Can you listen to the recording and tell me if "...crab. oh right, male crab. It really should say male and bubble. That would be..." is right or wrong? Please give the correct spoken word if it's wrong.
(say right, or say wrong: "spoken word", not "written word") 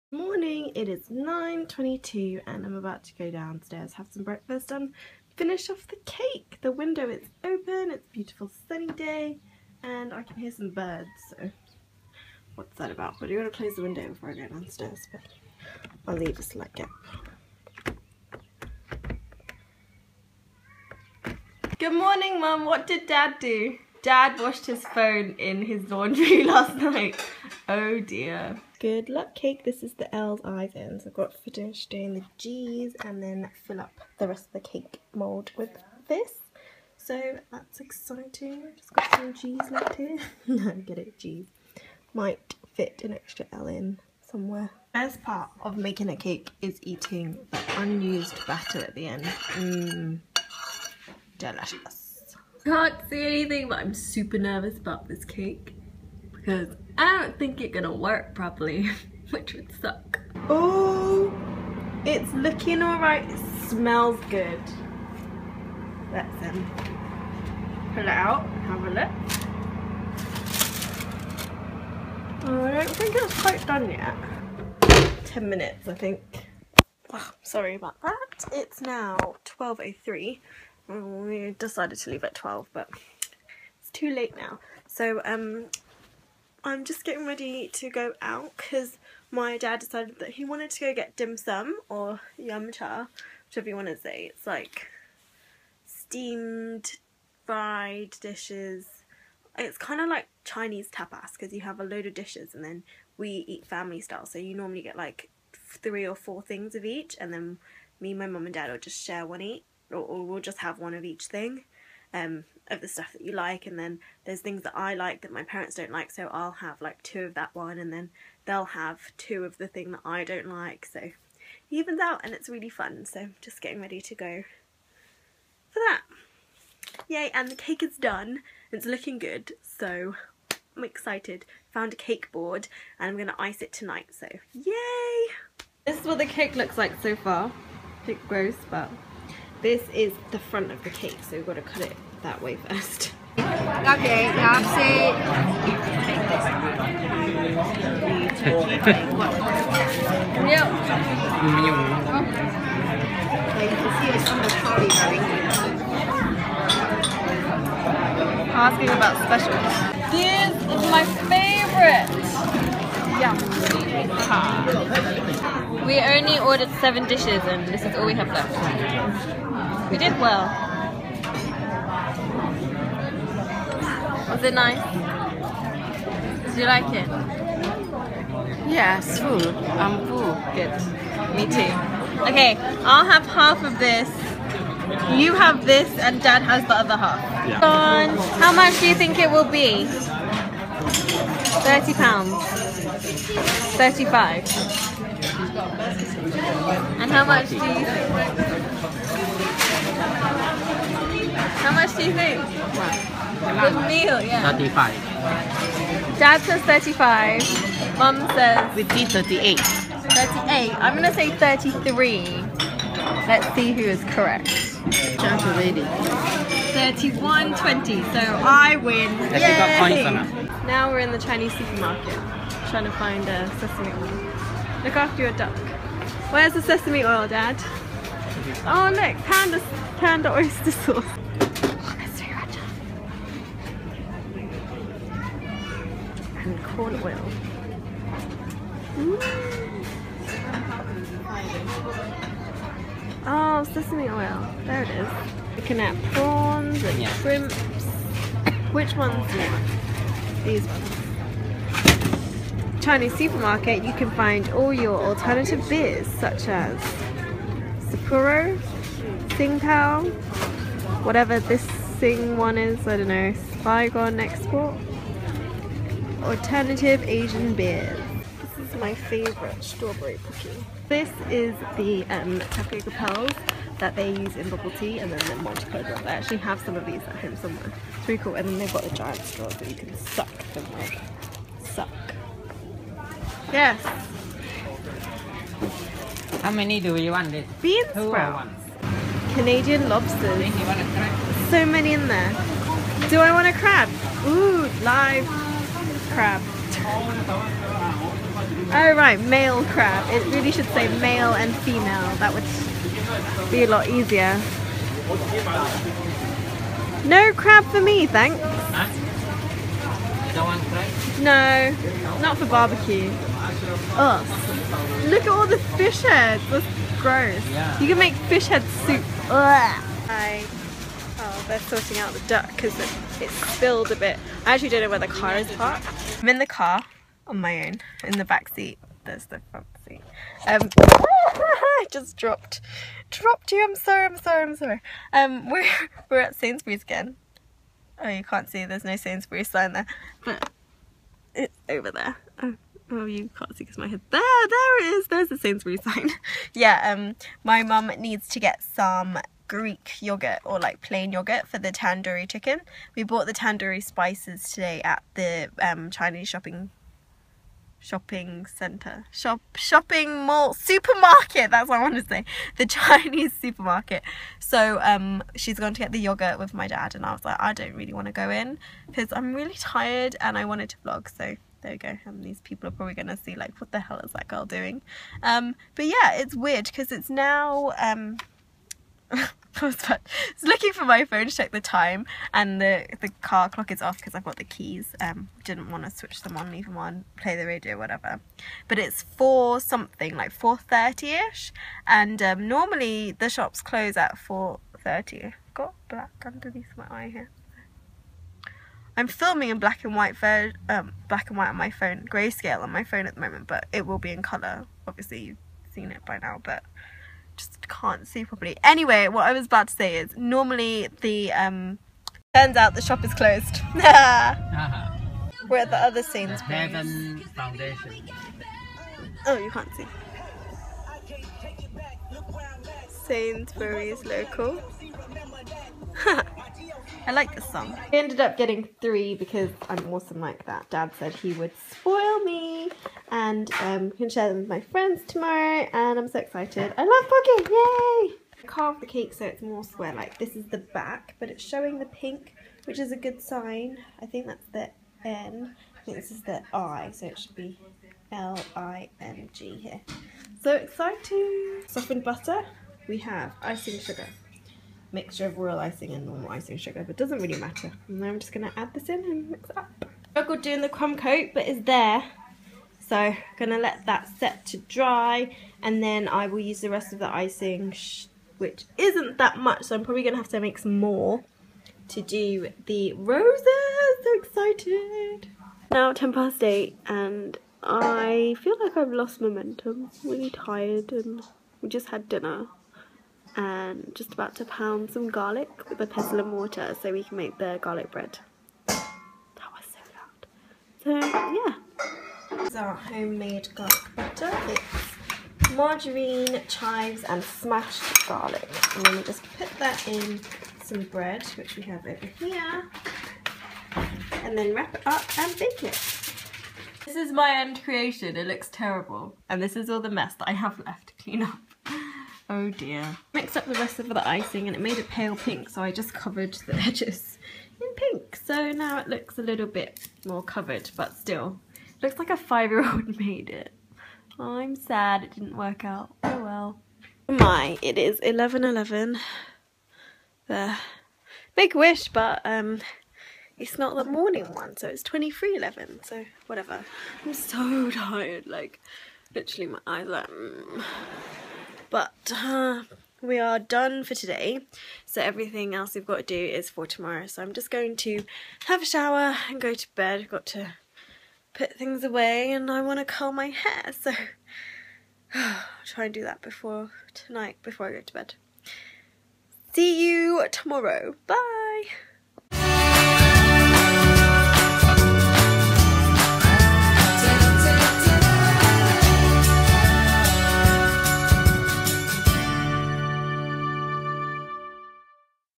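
wrong: "female", not "bubble".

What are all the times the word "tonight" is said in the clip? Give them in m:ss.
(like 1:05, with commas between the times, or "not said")
2:13, 9:16.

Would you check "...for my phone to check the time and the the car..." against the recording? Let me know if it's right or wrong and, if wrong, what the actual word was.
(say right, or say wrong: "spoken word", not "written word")
right.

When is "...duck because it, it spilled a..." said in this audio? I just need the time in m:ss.
5:22.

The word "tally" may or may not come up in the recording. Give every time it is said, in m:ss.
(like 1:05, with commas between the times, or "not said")
not said.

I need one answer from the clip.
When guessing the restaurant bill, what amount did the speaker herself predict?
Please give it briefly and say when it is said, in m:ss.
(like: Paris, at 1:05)
33 pounds, at 3:31.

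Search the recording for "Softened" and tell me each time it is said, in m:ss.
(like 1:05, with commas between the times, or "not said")
7:31.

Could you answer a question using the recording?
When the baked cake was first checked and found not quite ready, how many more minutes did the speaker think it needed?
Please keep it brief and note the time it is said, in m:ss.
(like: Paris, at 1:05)
10 minutes, at 1:15.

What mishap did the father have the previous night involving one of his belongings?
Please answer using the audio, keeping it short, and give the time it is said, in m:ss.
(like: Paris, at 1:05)
Washed his phone, at 0:24.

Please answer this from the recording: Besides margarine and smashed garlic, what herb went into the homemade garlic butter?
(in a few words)
Chives.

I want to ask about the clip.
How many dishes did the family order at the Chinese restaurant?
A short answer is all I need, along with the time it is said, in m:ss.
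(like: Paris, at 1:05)
Seven, at 2:46.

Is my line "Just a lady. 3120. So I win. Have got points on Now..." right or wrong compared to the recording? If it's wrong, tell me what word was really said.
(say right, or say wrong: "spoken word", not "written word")
right.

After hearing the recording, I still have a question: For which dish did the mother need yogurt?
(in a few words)
Tandoori chicken.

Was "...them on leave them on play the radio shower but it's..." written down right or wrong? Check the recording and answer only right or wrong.
wrong.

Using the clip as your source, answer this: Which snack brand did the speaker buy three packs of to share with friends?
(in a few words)
Pocky.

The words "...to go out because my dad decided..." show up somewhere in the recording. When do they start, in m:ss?
1:27.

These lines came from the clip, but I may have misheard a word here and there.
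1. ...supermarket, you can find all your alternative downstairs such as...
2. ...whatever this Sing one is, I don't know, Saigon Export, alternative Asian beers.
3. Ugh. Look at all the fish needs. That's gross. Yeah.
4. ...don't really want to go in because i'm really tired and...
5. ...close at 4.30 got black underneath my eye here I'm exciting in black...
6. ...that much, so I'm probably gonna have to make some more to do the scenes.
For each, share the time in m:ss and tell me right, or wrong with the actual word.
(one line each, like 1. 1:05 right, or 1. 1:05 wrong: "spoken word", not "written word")
1. 4:13 wrong: "beers", not "downstairs"
2. 4:21 right
3. 5:13 wrong: "heads", not "needs"
4. 6:07 right
5. 6:33 wrong: "filming", not "exciting"
6. 7:49 wrong: "roses", not "scenes".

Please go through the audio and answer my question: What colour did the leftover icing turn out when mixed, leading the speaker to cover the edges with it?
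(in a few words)
Pale pink.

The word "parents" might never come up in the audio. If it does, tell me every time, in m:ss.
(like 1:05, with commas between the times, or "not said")
1:55.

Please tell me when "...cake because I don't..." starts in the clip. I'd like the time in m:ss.
0:55.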